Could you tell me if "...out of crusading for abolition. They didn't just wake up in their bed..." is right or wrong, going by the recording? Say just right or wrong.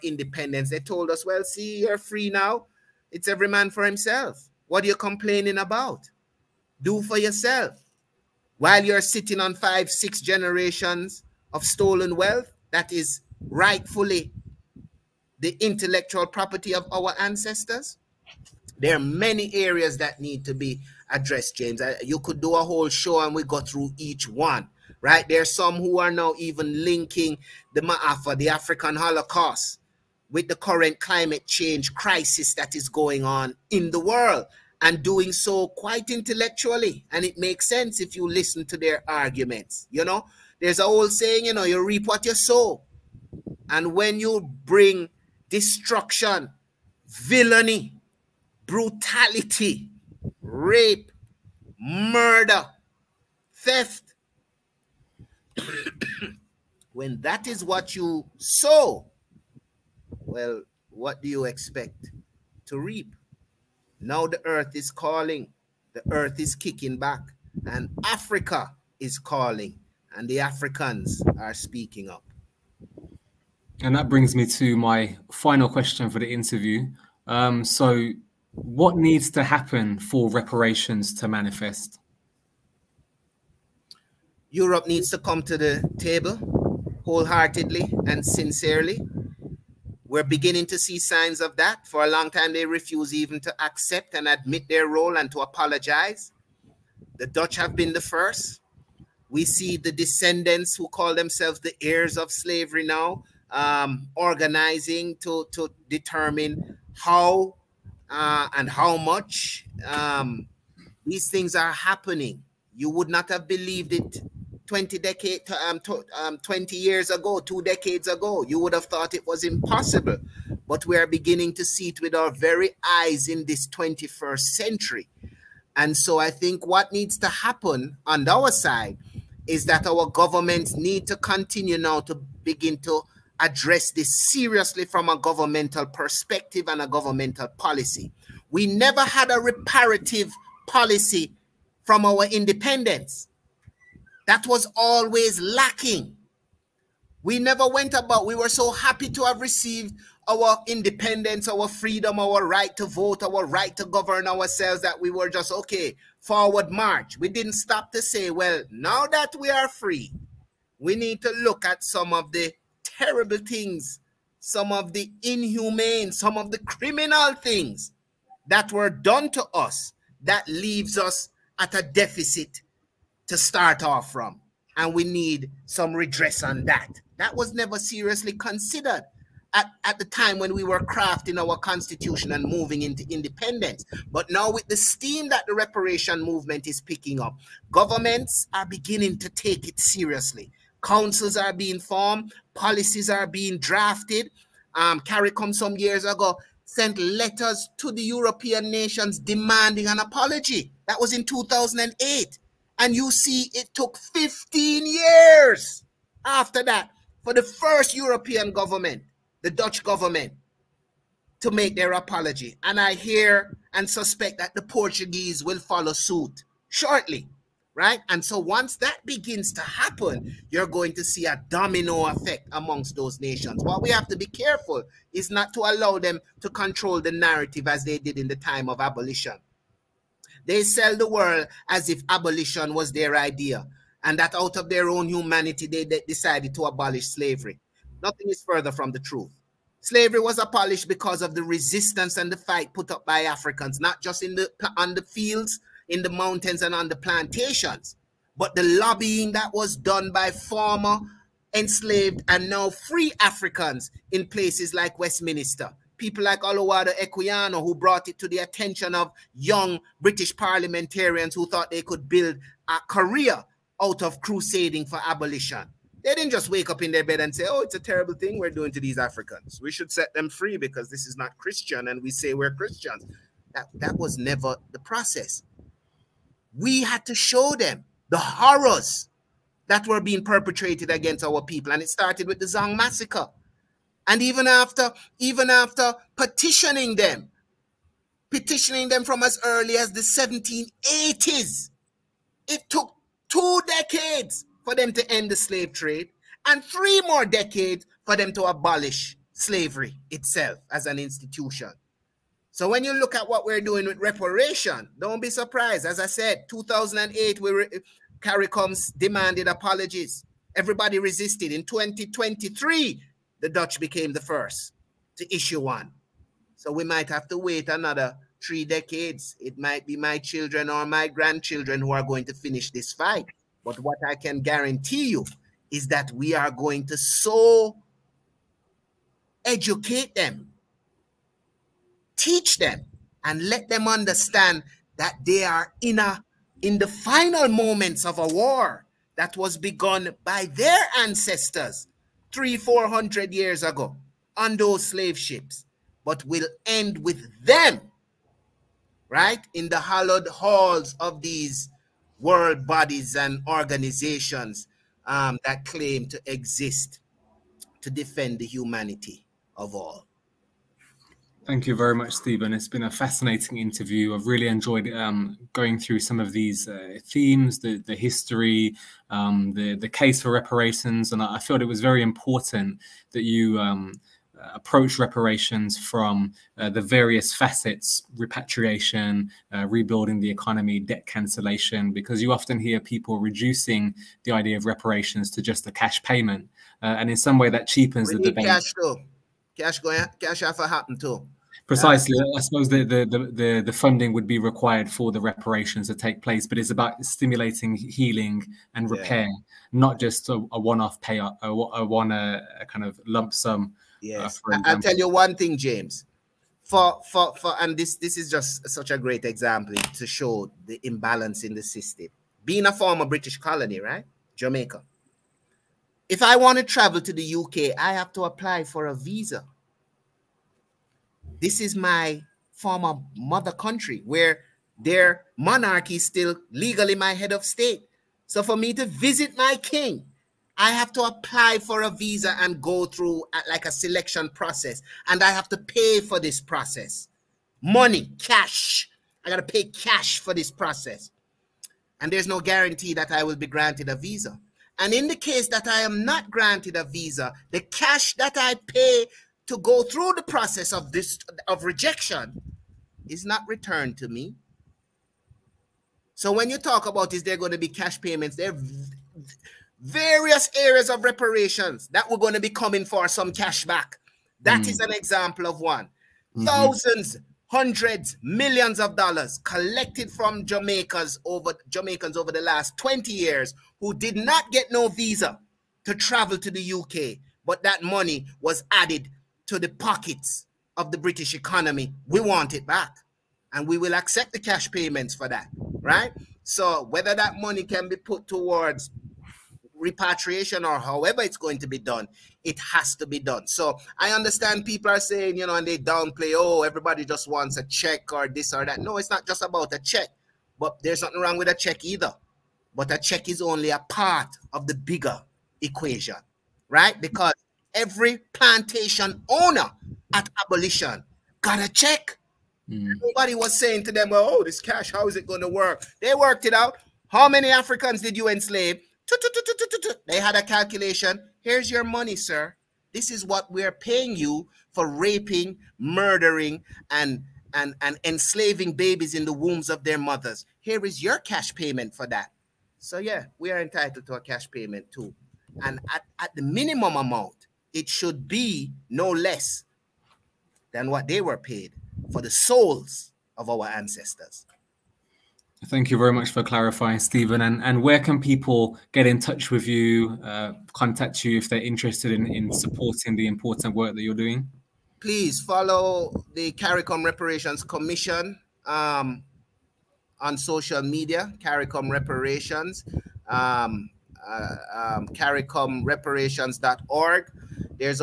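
right.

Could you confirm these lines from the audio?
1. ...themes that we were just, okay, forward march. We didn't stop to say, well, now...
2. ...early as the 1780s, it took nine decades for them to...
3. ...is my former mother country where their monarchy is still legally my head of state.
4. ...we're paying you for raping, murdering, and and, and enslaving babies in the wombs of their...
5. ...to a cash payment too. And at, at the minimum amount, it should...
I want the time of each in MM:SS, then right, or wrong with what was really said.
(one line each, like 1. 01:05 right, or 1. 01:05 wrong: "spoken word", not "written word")
1. 02:34 wrong: "ourselves", not "themes"
2. 04:49 wrong: "two", not "nine"
3. 07:01 right
4. 08:43 right
5. 08:54 right.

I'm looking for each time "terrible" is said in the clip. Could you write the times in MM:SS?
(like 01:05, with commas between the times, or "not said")
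02:42, 04:27.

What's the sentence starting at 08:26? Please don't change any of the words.
Because every plantation owner at abolition got a check.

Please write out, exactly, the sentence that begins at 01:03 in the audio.
Now the earth is calling, the earth is kicking back, and Africa is calling, and the Africans are speaking up.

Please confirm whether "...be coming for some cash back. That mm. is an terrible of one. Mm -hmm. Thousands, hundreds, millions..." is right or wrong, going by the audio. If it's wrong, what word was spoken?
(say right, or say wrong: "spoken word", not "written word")
wrong: "example", not "terrible".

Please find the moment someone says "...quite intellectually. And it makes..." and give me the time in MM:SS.
00:35.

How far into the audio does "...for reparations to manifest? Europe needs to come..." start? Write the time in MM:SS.
01:19.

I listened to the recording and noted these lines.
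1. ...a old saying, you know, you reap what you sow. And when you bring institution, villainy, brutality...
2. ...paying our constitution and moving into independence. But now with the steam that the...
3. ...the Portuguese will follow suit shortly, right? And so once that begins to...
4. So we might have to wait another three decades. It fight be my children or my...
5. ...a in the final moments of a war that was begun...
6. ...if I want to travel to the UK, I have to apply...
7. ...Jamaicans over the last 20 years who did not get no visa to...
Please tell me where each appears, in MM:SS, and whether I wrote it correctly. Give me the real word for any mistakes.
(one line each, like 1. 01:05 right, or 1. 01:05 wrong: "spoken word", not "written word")
1. 00:40 wrong: "destruction", not "institution"
2. 03:00 wrong: "crafting", not "paying"
3. 03:34 right
4. 05:16 wrong: "might", not "fight"
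5. 05:35 right
6. 06:56 right
7. 07:51 right.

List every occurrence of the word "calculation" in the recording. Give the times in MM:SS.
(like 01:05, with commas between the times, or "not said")
08:40.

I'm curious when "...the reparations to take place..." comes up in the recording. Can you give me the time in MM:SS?
06:35.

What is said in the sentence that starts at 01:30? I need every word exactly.
We're beginning to see signs of that.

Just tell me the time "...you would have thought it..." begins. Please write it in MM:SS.
01:58.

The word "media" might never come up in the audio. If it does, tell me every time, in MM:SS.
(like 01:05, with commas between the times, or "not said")
09:20.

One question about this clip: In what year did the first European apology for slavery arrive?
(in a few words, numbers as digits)
2023.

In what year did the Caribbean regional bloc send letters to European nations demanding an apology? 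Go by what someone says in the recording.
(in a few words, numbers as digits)
2008.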